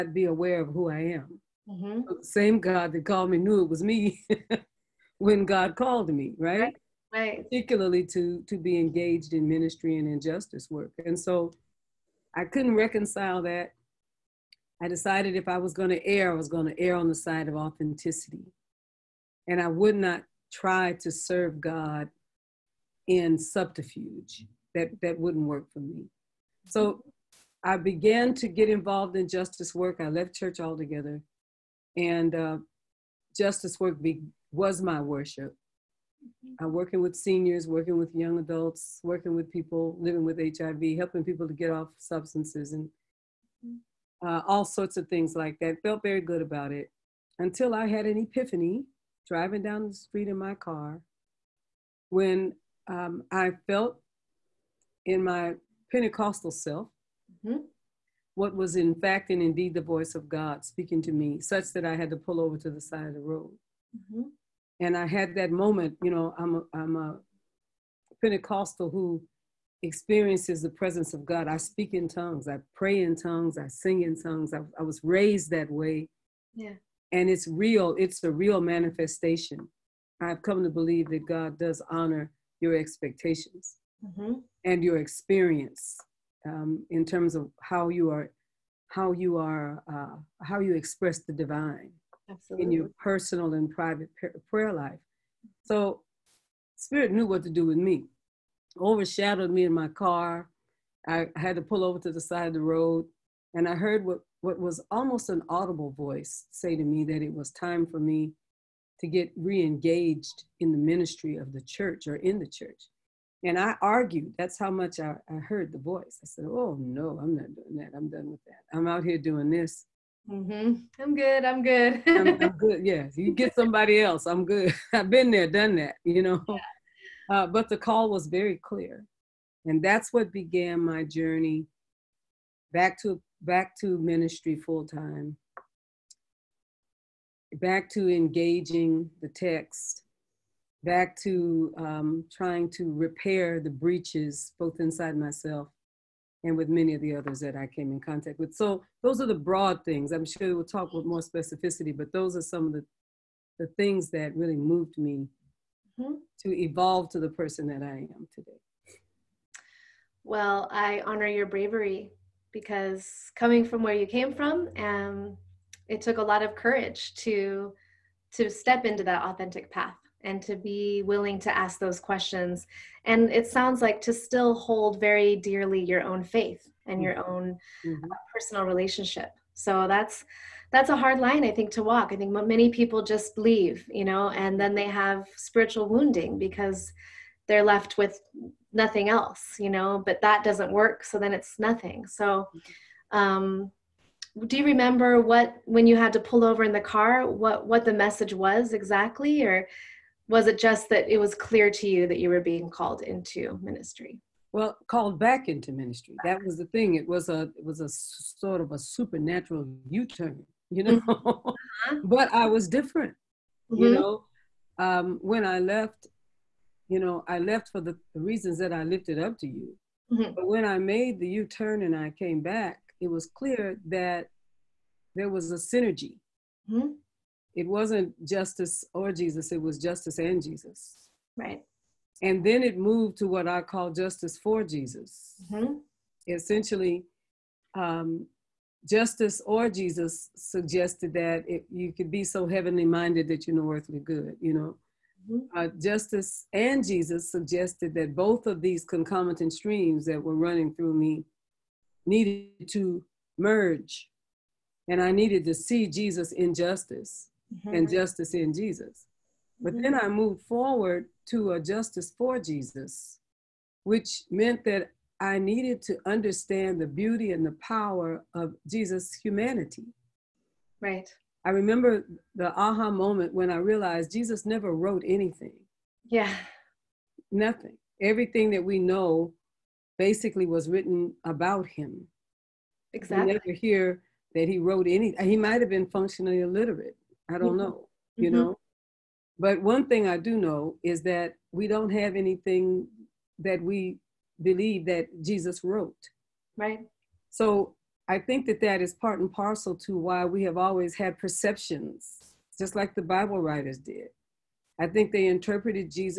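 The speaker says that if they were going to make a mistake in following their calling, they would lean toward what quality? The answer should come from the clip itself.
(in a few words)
authenticity.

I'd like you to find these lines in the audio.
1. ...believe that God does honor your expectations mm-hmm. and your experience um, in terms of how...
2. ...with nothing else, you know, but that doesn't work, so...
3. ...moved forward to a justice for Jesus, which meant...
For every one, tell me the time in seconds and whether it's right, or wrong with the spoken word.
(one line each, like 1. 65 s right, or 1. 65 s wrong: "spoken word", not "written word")
1. 80 s right
2. 187 s right
3. 260 s right.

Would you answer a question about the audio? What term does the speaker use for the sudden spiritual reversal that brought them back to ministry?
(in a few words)
supernatural u-turn.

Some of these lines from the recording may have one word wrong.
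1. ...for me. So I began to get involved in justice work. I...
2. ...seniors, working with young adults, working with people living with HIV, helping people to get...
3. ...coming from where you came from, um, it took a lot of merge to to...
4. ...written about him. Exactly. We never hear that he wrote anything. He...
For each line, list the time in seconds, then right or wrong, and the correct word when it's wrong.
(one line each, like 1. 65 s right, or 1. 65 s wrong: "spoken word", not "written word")
1. 25 s right
2. 37 s right
3. 163 s wrong: "courage", not "merge"
4. 280 s right.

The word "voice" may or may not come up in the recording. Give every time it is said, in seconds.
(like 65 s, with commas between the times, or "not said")
59 s, 105 s, 115 s.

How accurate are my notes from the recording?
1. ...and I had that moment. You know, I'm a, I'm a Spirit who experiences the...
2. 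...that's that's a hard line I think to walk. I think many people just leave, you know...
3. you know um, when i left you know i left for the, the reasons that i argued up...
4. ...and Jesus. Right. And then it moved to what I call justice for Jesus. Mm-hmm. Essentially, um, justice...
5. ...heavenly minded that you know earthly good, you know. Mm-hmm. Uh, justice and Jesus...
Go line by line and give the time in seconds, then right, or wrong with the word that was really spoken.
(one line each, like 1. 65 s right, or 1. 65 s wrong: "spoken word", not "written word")
1. 64 s wrong: "Pentecostal", not "Spirit"
2. 179 s right
3. 213 s wrong: "lifted", not "argued"
4. 230 s right
5. 242 s right.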